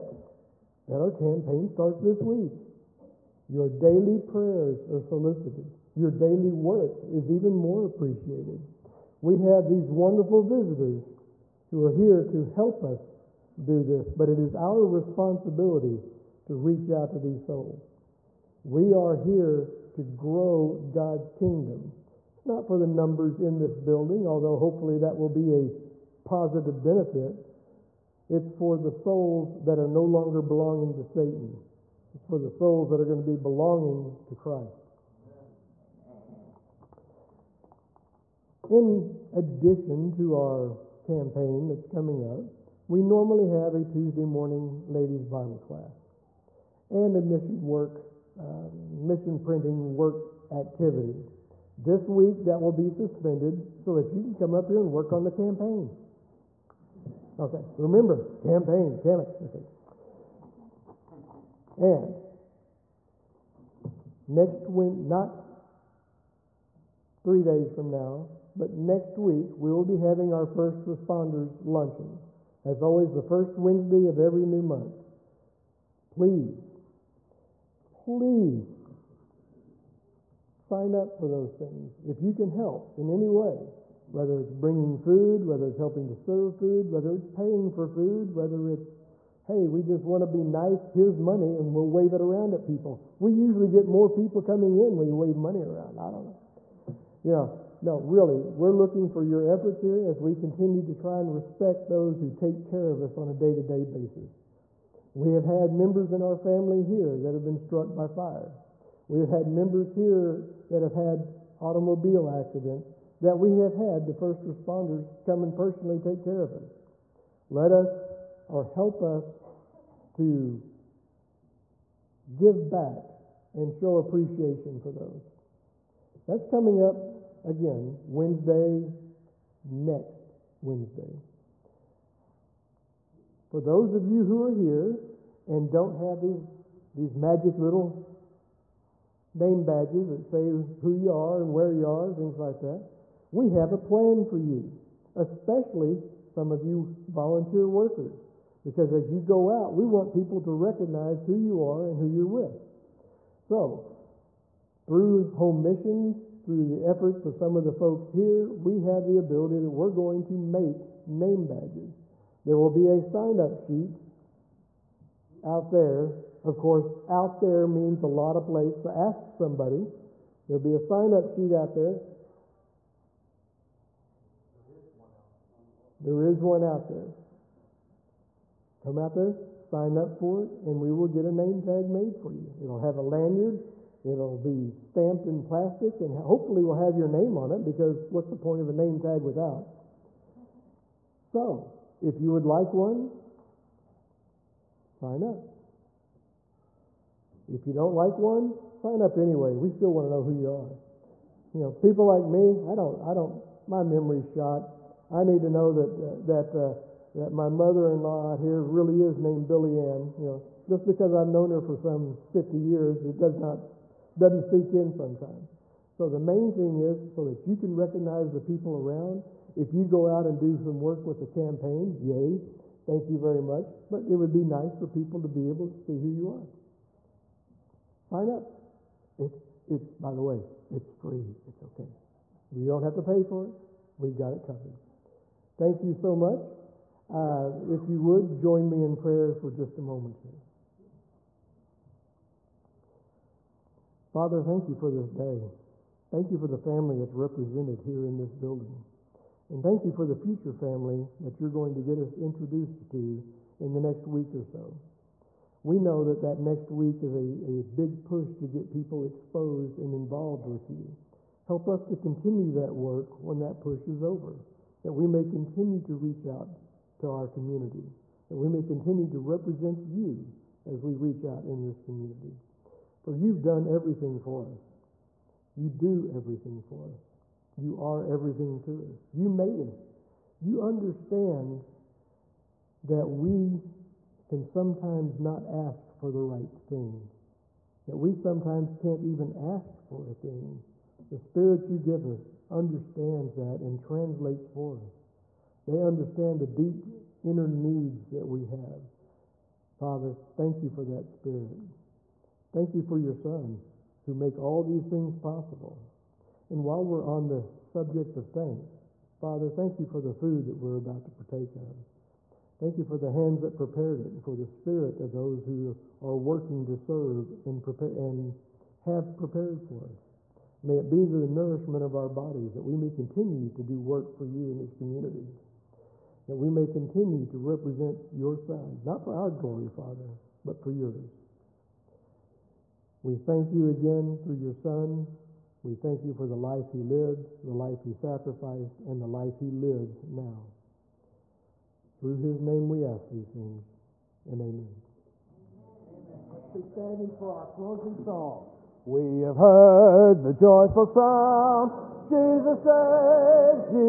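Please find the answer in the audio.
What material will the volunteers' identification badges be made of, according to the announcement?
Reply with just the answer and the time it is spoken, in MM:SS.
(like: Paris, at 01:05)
Plastic, at 03:05.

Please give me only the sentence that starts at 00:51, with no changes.
This week, that will be suspended so that you can come up here and work on the campaign.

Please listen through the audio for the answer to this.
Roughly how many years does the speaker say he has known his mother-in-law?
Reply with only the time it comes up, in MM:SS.
03:32.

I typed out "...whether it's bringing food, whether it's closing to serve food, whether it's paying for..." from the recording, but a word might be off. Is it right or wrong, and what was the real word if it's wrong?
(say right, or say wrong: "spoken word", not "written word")
wrong: "helping", not "closing".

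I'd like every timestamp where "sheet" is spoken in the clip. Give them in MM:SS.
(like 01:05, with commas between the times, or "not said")
02:43, 02:51.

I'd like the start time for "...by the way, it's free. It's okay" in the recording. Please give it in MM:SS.
03:49.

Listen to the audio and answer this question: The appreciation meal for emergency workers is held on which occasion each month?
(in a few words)
First Wednesday.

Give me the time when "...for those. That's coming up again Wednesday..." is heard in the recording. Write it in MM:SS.
02:04.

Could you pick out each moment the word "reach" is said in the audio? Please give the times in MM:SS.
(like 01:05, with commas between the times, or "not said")
00:16, 04:25, 04:30.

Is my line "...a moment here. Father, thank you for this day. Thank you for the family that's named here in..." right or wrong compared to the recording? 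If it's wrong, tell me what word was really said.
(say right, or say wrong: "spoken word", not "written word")
wrong: "represented", not "named".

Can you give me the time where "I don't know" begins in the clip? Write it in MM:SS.
01:35.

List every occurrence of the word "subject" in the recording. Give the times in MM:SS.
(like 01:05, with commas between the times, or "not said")
05:07.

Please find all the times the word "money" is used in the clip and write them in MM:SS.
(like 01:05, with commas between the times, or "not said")
01:31, 01:35.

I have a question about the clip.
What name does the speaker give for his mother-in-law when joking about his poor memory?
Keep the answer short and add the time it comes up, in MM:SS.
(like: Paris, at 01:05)
Billy Ann, at 03:29.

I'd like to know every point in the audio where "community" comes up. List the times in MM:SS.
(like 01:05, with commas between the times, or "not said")
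04:27, 04:31, 05:24.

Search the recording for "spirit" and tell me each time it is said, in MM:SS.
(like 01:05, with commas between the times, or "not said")
04:51, 05:01, 05:14.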